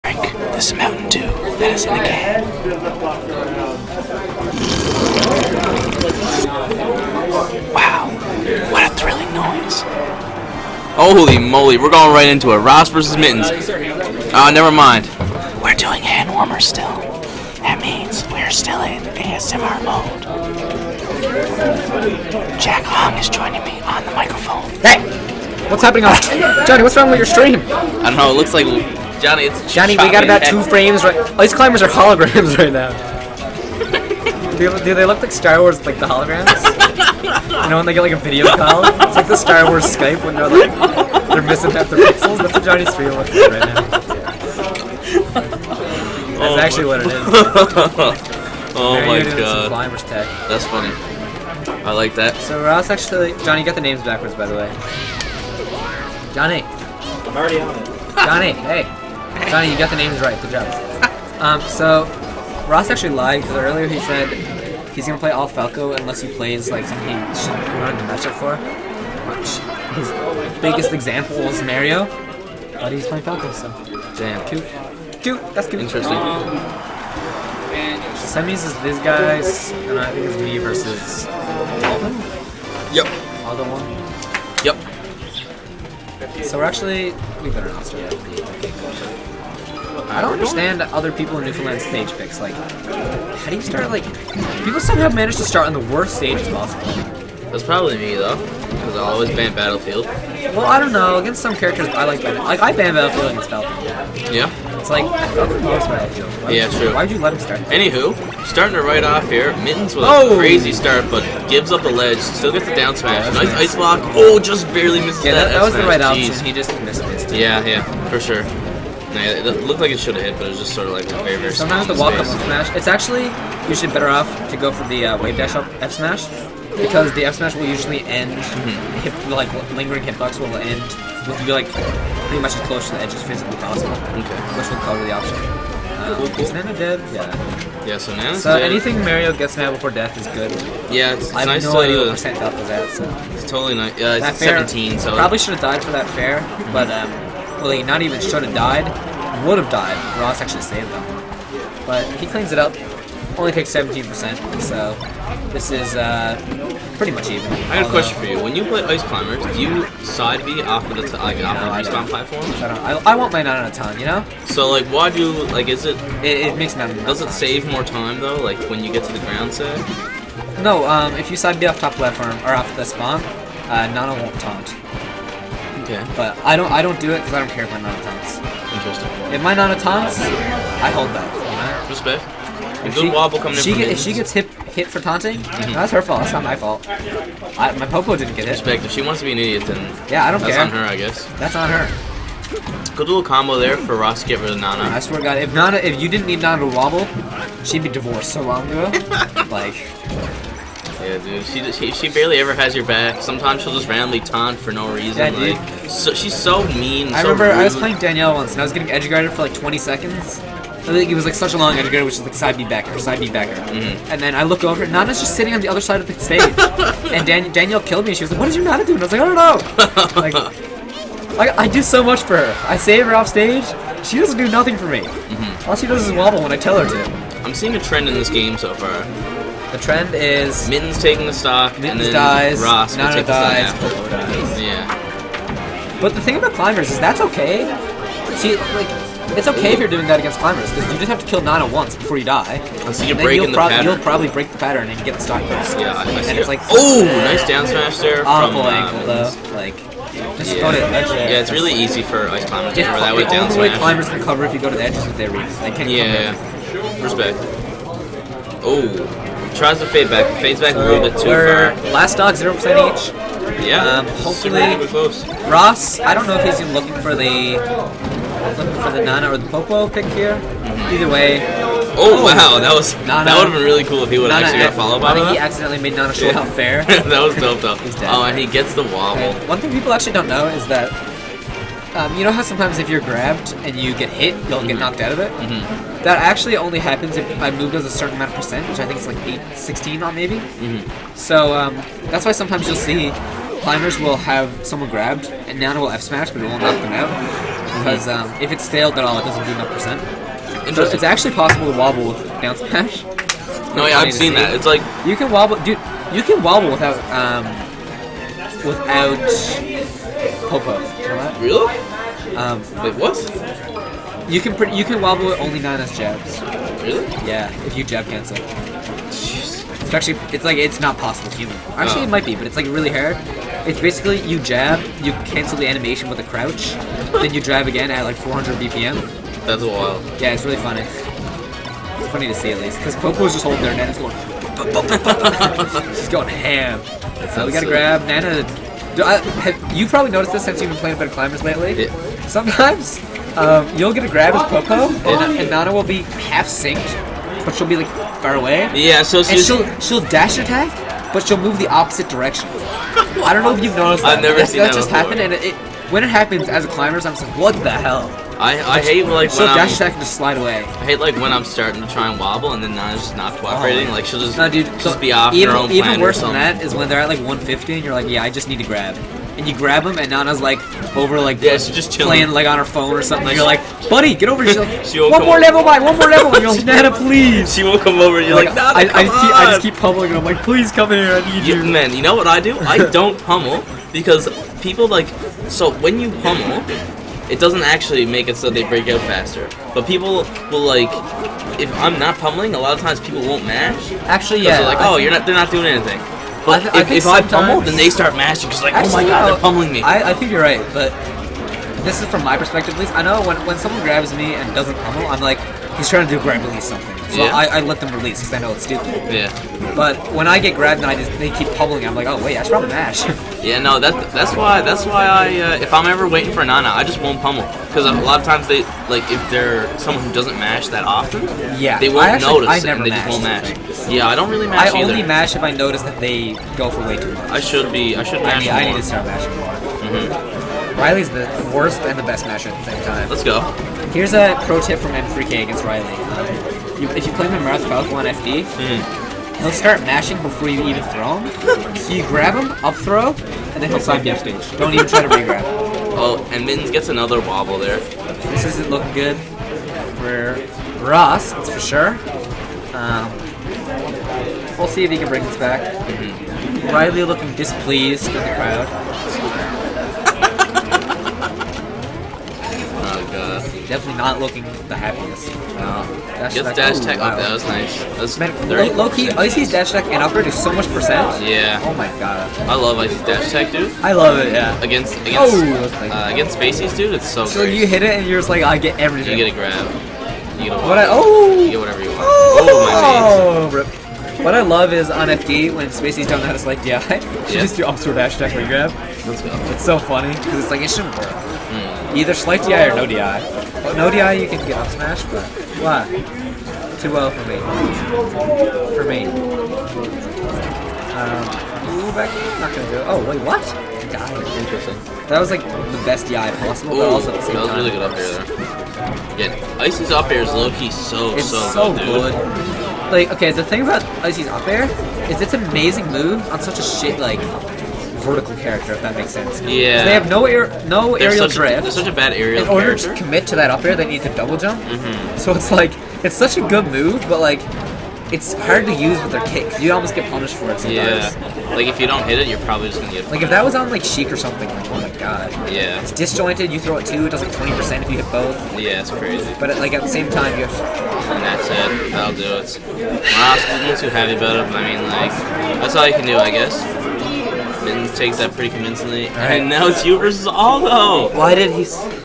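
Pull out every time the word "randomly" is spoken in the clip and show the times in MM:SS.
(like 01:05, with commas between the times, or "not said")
03:23.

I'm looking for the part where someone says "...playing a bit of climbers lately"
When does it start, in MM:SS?
05:40.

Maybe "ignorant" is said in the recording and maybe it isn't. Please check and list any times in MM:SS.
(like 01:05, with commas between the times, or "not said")
not said.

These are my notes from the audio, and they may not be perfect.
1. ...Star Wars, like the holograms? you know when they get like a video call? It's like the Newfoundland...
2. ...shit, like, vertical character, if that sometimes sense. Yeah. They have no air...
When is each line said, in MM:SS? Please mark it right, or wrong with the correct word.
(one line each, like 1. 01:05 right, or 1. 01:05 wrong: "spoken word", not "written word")
1. 00:35 wrong: "Star", not "Newfoundland"
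2. 08:36 wrong: "makes", not "sometimes".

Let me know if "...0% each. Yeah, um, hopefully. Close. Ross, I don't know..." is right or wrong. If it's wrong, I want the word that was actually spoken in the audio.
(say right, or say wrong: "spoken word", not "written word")
right.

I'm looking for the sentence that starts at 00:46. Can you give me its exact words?
That's oh actually what it is.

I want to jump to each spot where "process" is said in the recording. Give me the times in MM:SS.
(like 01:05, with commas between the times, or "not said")
not said.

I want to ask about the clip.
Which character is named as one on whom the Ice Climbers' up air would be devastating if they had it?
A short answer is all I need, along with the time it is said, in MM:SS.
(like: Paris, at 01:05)
Sheik, at 08:53.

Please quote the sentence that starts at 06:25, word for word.
So when you pummel, it doesn't actually make it so they break out faster.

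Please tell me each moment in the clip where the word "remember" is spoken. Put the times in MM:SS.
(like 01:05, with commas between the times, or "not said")
03:27.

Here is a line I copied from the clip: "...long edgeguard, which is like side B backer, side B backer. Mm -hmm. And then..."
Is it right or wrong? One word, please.
right.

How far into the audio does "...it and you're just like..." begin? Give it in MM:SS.
07:57.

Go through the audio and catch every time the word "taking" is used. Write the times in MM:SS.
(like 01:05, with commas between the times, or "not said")
03:51.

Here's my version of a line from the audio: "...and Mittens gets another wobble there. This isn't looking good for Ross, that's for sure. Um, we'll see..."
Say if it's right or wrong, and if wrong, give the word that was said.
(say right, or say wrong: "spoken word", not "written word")
right.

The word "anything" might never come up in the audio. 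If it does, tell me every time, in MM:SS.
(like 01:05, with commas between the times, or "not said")
02:18, 06:35.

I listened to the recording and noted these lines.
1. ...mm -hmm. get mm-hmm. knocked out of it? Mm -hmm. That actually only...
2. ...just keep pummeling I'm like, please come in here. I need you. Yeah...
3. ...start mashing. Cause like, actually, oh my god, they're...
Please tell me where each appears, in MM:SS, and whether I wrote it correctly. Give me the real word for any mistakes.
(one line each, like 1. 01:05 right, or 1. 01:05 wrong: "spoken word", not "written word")
1. 04:44 right
2. 06:19 right
3. 06:37 right.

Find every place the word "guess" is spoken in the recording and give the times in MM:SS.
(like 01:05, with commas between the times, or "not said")
03:10, 09:06.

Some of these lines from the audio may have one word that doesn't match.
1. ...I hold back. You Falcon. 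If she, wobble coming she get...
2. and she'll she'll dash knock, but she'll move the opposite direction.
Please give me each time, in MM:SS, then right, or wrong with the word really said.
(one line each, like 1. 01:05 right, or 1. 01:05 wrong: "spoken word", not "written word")
1. 03:00 wrong: "Respect", not "Falcon"
2. 05:49 wrong: "attack", not "knock".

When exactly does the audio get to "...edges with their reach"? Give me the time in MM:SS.
04:14.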